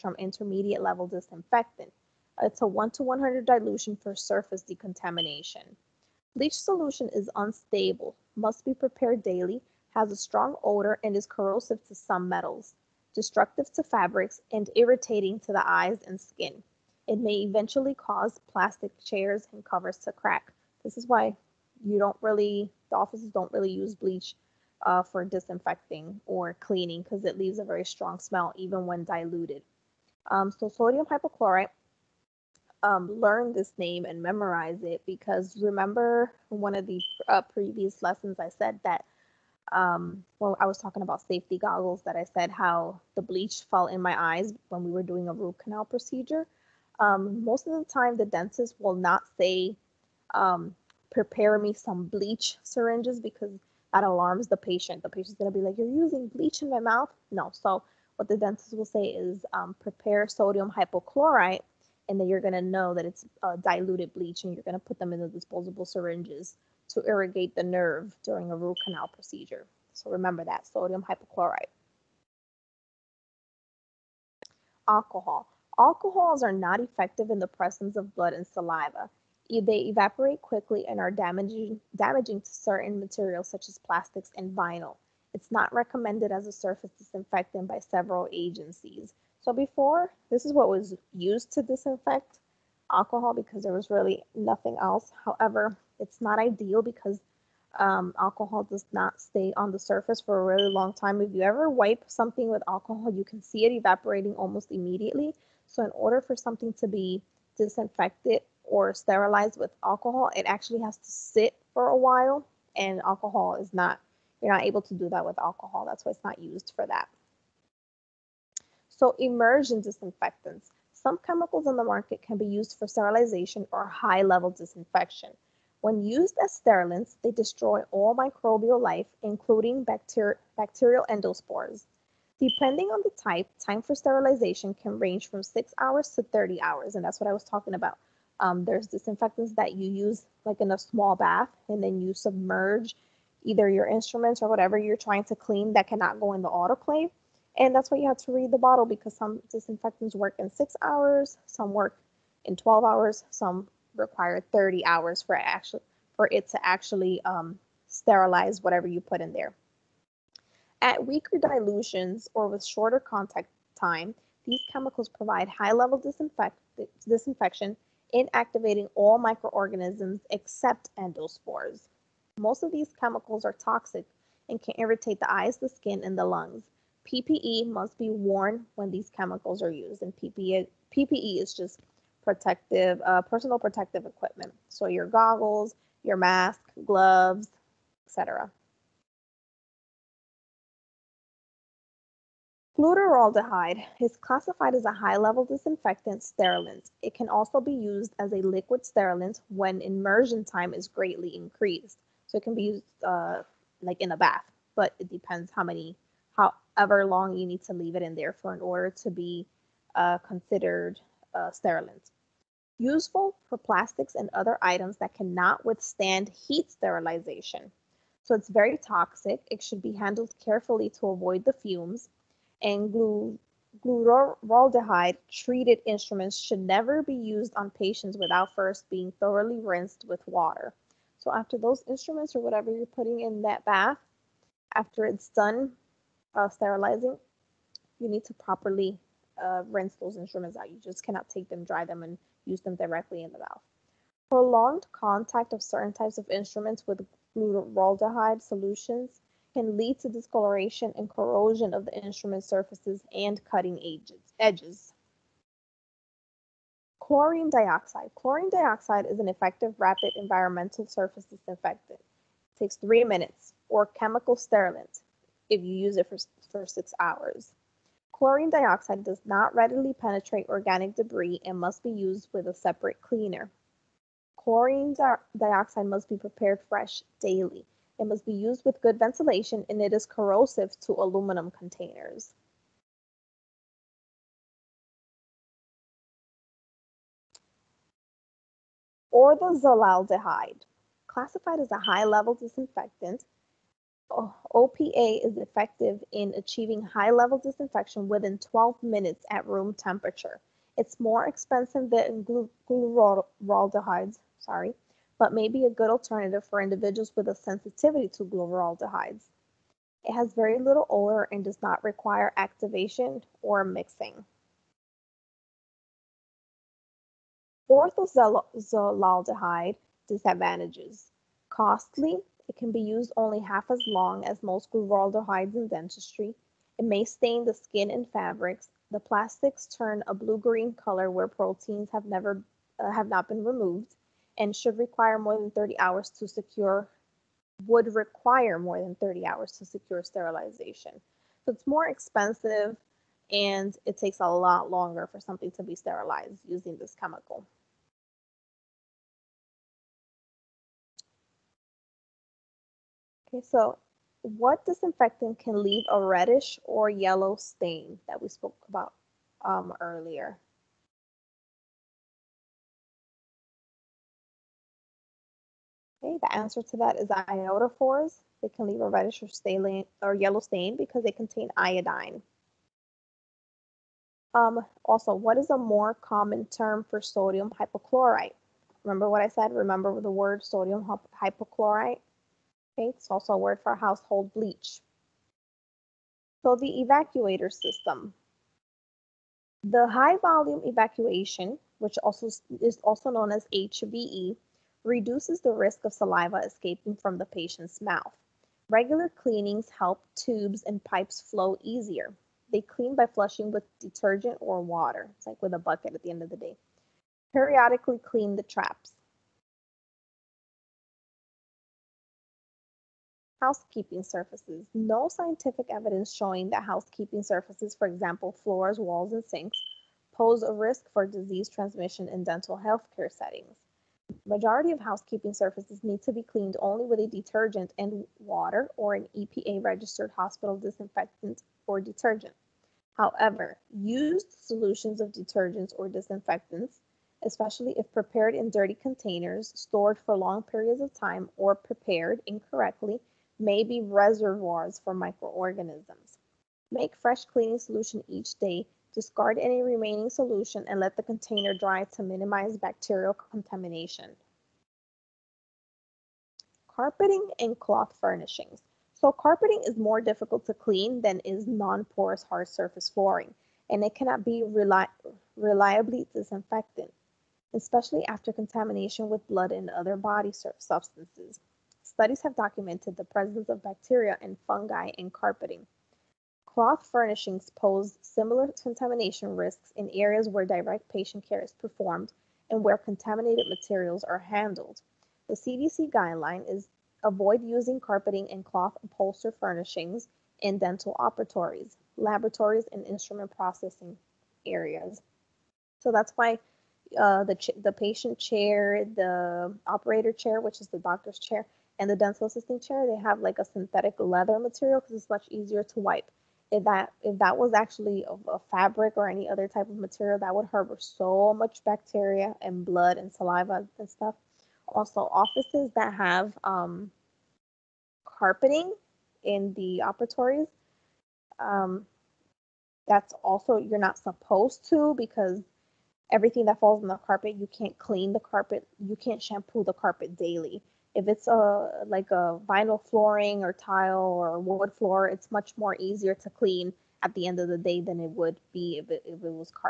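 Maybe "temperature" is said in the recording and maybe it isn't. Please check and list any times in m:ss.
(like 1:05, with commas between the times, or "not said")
4:59.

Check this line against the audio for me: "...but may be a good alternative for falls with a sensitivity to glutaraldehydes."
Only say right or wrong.
wrong.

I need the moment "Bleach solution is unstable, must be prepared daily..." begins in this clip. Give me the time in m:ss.
0:06.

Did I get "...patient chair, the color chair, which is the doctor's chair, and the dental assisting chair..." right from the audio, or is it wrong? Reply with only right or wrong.
wrong.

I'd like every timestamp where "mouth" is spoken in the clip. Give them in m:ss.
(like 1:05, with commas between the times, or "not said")
0:56, 4:03, 6:37.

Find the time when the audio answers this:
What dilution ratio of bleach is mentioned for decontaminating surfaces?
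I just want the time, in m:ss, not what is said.
0:02.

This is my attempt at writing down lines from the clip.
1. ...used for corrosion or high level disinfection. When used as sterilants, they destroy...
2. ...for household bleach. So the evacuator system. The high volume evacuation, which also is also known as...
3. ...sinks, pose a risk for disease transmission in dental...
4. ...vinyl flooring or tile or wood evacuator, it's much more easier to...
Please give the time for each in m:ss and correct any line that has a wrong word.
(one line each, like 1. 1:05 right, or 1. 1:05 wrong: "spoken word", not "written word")
1. 2:02 wrong: "sterilization", not "corrosion"
2. 6:23 right
3. 6:59 right
4. 8:52 wrong: "floor", not "evacuator".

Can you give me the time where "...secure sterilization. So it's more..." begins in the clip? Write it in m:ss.
5:39.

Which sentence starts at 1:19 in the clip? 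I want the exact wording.
They evaporate quickly and are damaging, damaging to certain materials such as plastics and vinyl.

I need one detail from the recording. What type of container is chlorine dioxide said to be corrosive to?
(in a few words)
aluminum.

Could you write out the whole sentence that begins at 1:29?
So before, this is what was used to disinfect alcohol because there was really nothing else.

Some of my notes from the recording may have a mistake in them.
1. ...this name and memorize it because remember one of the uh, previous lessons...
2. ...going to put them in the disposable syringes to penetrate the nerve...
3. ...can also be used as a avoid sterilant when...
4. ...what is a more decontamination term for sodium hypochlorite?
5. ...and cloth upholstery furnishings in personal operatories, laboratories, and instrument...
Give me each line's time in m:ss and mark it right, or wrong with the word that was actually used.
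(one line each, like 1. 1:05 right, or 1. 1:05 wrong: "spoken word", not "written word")
1. 0:33 right
2. 1:04 wrong: "irrigate", not "penetrate"
3. 3:17 wrong: "liquid", not "avoid"
4. 6:15 wrong: "common", not "decontamination"
5. 8:08 wrong: "dental", not "personal".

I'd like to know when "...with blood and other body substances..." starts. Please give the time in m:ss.
7:49.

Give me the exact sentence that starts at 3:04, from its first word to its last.
So your goggles, your mask, gloves, etc.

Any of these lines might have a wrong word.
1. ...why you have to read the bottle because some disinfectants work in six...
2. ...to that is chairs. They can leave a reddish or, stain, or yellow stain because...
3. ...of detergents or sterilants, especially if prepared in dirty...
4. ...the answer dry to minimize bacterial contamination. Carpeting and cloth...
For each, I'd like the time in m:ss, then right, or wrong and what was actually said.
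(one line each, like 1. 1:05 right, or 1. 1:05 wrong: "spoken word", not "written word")
1. 2:27 right
2. 6:06 wrong: "iodophors", not "chairs"
3. 7:15 wrong: "disinfectants", not "sterilants"
4. 7:30 wrong: "container", not "answer".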